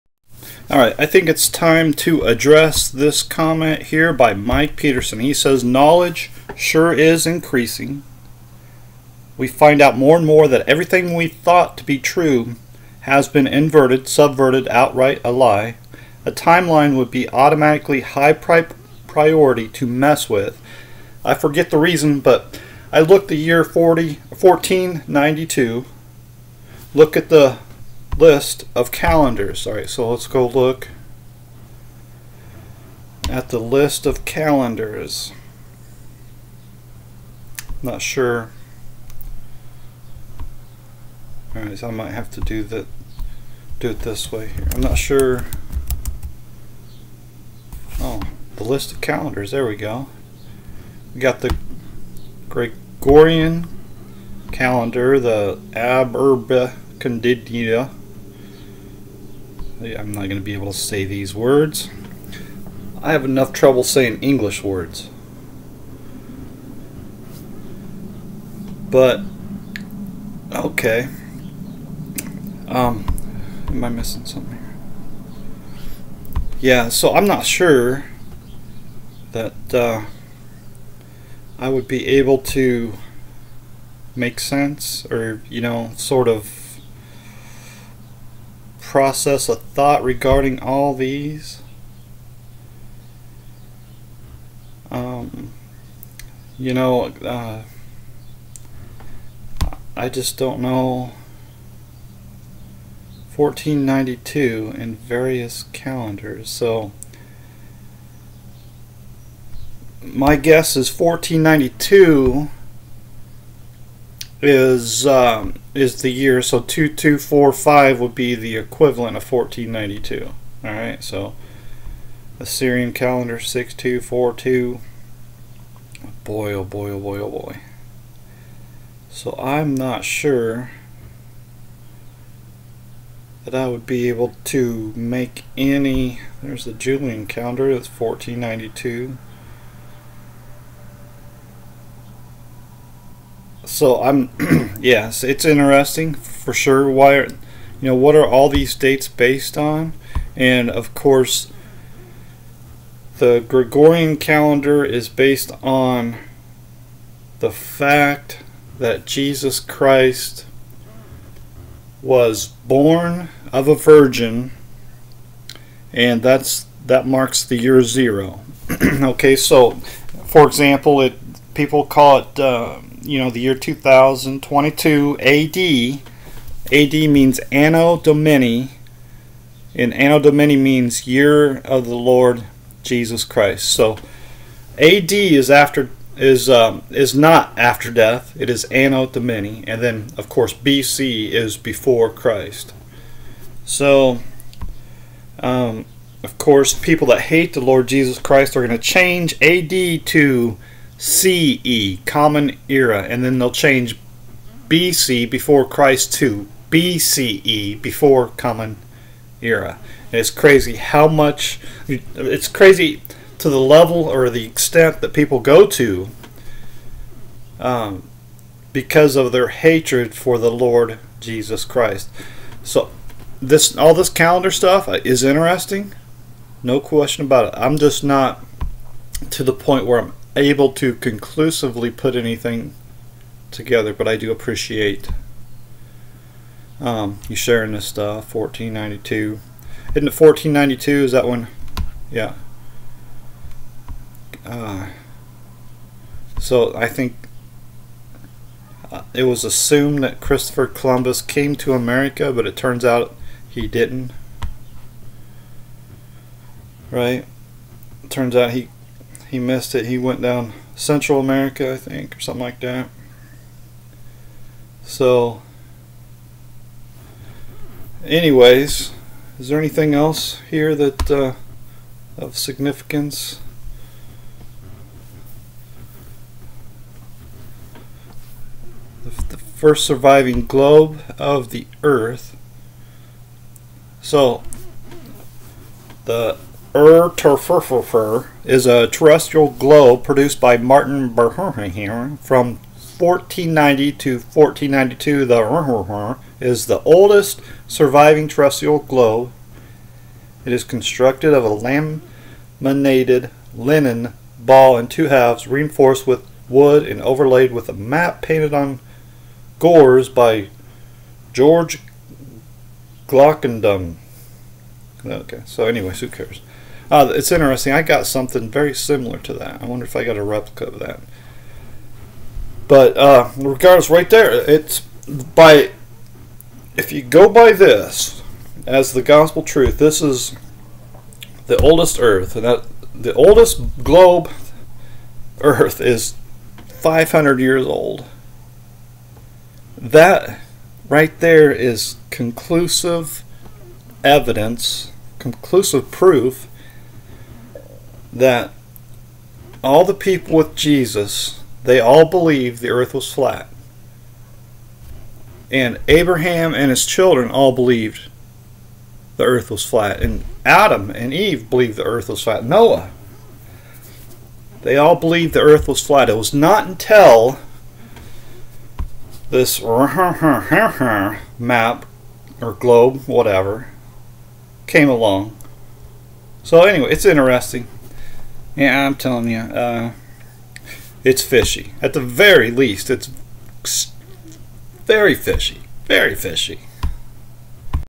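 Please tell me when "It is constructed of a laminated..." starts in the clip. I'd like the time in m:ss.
5:00.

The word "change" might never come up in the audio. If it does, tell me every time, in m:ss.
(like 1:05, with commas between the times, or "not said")
3:18, 3:23.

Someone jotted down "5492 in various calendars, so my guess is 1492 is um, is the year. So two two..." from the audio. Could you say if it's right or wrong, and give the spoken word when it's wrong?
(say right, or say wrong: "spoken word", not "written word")
wrong: "1492", not "5492".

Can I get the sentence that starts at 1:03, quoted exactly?
I have enough trouble saying English words.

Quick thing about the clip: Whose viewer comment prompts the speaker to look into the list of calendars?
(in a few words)
Mike Peterson.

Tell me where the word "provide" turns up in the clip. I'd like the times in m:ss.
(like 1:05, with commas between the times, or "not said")
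not said.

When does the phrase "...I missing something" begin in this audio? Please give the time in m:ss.
1:13.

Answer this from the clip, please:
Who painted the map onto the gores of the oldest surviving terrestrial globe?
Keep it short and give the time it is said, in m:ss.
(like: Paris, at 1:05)
George Glockendon, at 5:11.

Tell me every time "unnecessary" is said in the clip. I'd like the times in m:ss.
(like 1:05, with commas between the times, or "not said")
not said.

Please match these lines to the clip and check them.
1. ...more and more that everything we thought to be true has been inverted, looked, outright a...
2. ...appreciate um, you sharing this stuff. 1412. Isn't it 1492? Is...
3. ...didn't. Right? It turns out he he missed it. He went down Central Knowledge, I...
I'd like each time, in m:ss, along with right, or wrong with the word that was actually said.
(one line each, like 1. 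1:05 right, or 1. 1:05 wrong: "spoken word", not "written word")
1. 0:09 wrong: "subverted", not "looked"
2. 3:54 wrong: "1492", not "1412"
3. 4:13 wrong: "America", not "Knowledge".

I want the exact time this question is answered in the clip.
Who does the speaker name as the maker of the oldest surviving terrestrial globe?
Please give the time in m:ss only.
4:50.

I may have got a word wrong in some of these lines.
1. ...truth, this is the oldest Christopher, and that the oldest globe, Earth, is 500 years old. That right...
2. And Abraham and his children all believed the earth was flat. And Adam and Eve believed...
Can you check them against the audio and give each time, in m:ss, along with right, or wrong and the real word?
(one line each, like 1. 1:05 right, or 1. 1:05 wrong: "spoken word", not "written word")
1. 5:29 wrong: "Earth", not "Christopher"
2. 5:55 right.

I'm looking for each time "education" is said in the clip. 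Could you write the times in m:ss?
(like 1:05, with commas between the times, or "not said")
not said.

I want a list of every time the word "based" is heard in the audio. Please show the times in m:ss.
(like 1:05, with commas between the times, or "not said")
2:29, 2:35.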